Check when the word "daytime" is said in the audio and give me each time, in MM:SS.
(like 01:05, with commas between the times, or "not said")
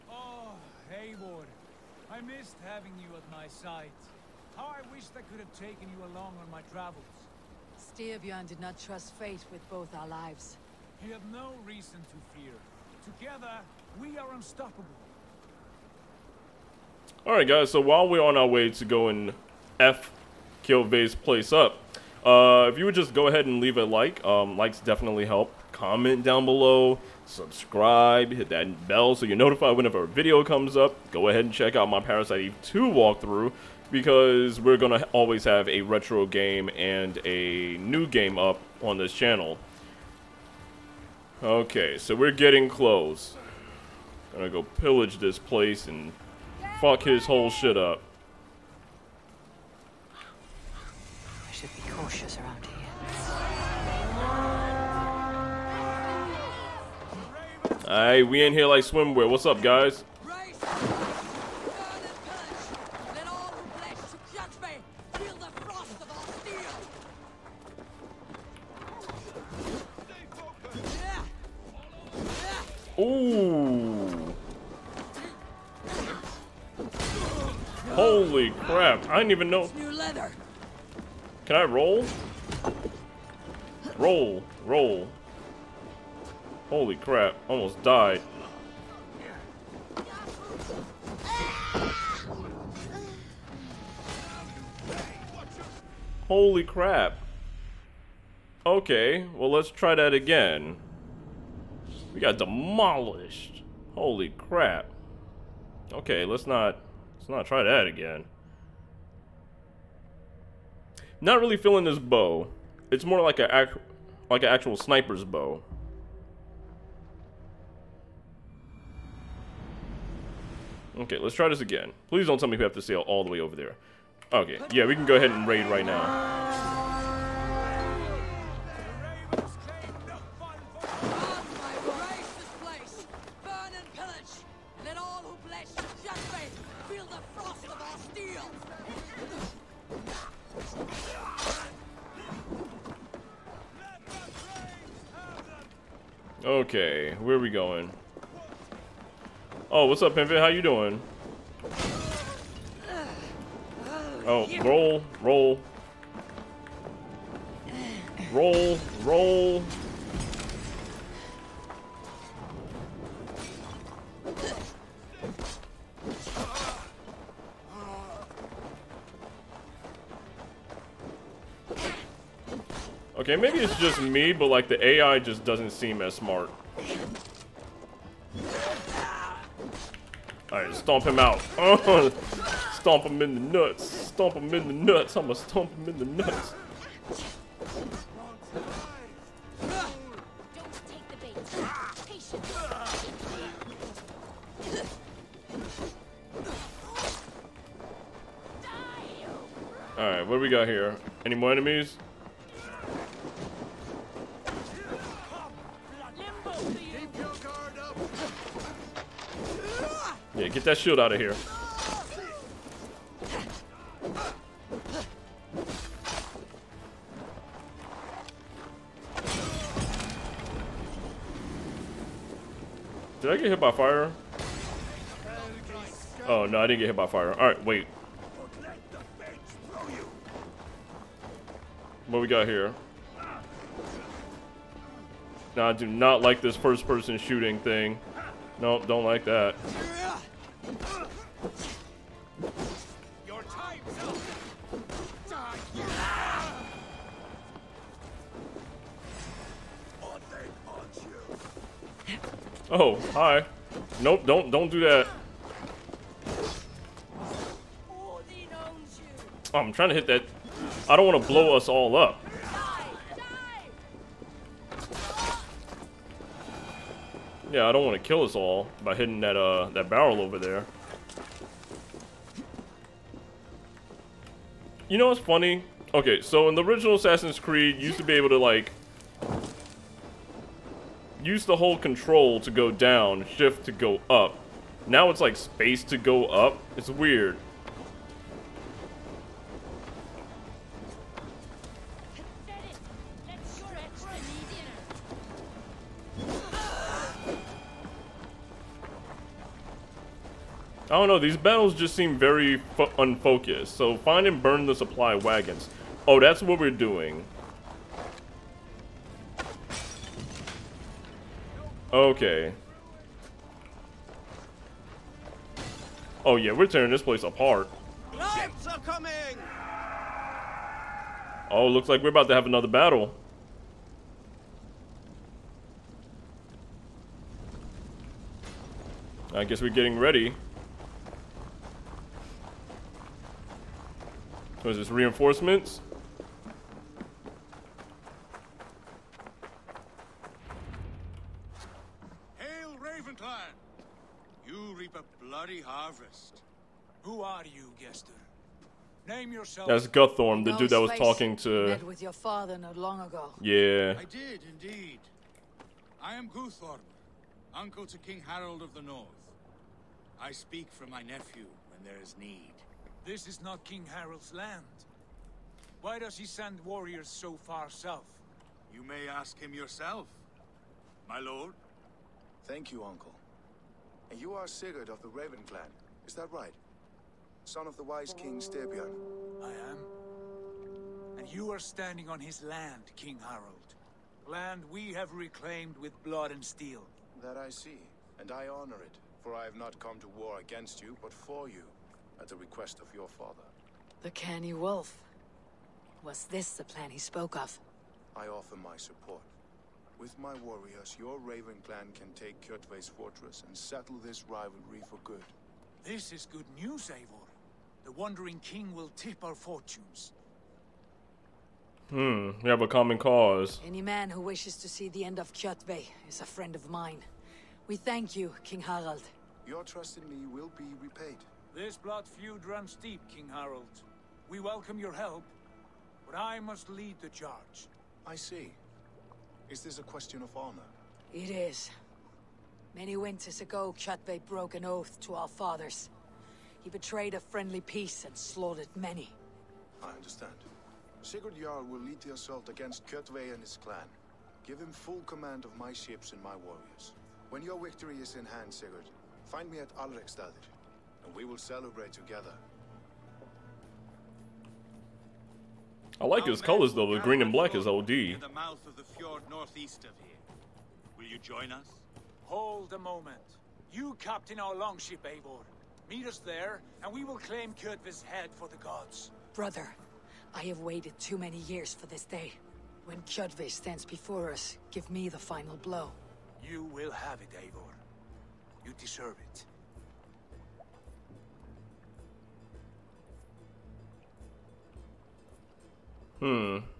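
not said.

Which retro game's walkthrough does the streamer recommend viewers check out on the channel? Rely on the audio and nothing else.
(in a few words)
Parasite Eve 2.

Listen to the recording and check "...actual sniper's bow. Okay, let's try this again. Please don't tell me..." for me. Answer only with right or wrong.
right.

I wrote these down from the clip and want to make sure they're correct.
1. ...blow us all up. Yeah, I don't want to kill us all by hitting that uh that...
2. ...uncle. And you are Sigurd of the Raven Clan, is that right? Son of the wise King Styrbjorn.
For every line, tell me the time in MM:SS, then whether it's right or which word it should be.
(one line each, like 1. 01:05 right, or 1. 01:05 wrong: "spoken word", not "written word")
1. 04:21 right
2. 06:12 right.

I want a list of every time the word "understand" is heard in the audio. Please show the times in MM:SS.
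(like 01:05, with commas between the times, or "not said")
07:19.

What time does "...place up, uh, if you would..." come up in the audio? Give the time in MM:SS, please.
00:21.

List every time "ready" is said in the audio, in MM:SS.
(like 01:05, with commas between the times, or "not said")
05:29.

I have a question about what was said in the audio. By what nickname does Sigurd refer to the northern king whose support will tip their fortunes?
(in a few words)
The Wandering King.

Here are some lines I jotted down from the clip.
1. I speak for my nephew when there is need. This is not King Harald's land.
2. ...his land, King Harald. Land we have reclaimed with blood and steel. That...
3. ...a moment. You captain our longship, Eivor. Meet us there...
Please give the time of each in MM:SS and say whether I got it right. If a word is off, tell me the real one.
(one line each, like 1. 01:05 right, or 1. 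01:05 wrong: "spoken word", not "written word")
1. 06:00 right
2. 06:22 right
3. 07:42 right.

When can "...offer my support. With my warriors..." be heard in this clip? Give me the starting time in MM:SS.
06:38.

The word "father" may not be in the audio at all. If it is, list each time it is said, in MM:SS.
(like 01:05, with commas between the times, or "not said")
05:52, 06:33, 07:15.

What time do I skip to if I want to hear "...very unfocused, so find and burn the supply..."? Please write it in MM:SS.
05:02.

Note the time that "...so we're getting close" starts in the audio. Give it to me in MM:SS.
00:41.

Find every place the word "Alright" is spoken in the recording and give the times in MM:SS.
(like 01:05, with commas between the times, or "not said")
00:17, 03:19.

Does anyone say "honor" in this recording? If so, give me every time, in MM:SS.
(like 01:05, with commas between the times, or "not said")
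06:28, 07:10.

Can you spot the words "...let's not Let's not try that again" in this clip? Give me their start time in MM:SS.
01:46.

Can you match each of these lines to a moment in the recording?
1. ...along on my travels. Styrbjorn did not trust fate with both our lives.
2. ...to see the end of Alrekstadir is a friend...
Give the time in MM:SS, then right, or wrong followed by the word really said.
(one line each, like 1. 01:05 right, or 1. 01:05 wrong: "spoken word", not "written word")
1. 00:06 right
2. 06:54 wrong: "Kjotve", not "Alrekstadir".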